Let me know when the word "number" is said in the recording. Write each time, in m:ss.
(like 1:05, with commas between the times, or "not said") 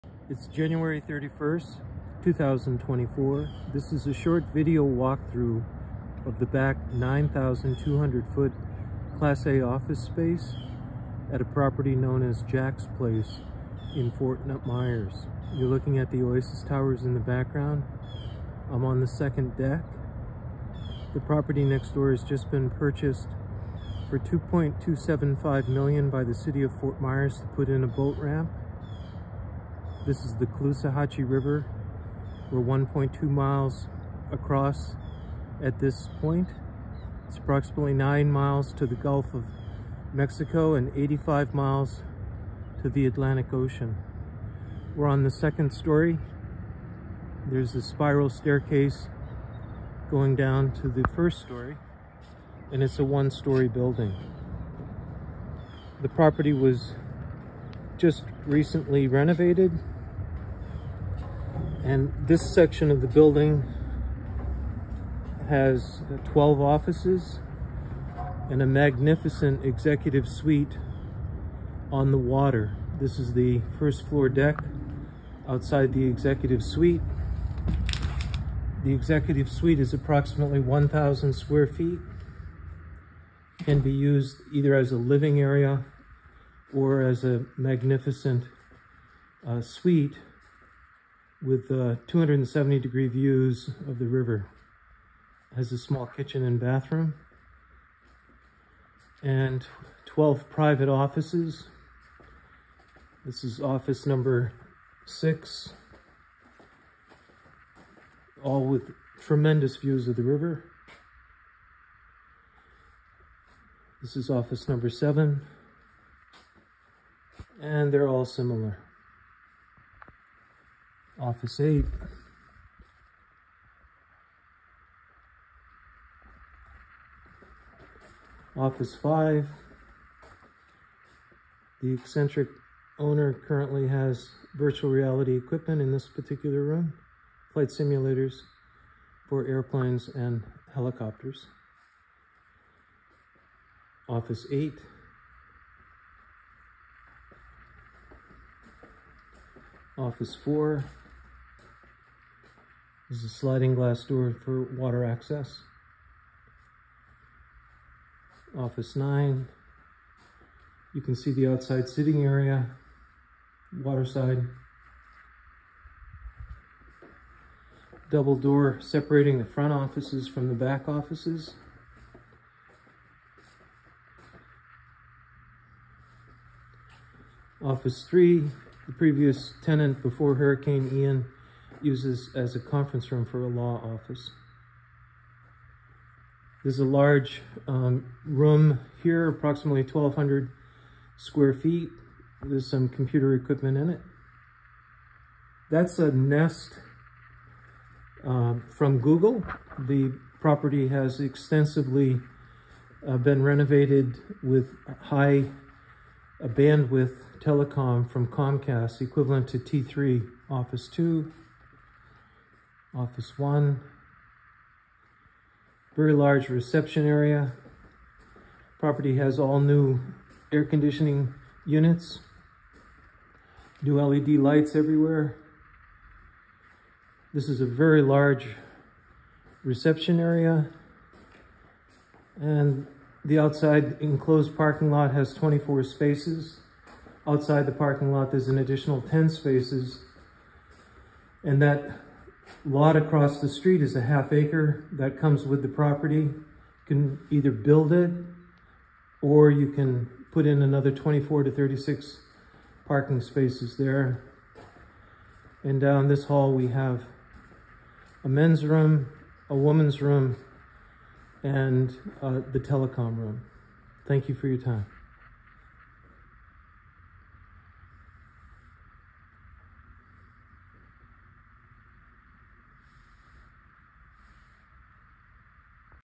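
1:44, 1:54.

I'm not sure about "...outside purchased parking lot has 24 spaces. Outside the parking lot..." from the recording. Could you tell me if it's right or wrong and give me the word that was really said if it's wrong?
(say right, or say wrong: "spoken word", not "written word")
wrong: "enclosed", not "purchased".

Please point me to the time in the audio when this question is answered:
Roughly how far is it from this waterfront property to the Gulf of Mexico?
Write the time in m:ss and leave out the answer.
0:37.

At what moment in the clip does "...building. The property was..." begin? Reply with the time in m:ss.
0:53.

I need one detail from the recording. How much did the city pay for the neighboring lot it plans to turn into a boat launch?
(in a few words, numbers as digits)
$2.275 million.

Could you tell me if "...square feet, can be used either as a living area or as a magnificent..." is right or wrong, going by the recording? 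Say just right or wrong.
right.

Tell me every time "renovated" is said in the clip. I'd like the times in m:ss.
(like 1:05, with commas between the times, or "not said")
0:59, 3:23.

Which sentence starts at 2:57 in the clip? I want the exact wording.
Office 3, the previous tenant before Hurricane Ian uses as a conference room for a law office.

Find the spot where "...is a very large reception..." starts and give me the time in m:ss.
3:47.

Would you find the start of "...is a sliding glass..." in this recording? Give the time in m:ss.
2:33.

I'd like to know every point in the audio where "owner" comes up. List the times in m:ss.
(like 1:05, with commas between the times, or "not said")
2:12.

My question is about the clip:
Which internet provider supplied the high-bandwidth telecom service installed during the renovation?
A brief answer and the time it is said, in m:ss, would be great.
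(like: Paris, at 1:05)
Comcast, at 3:28.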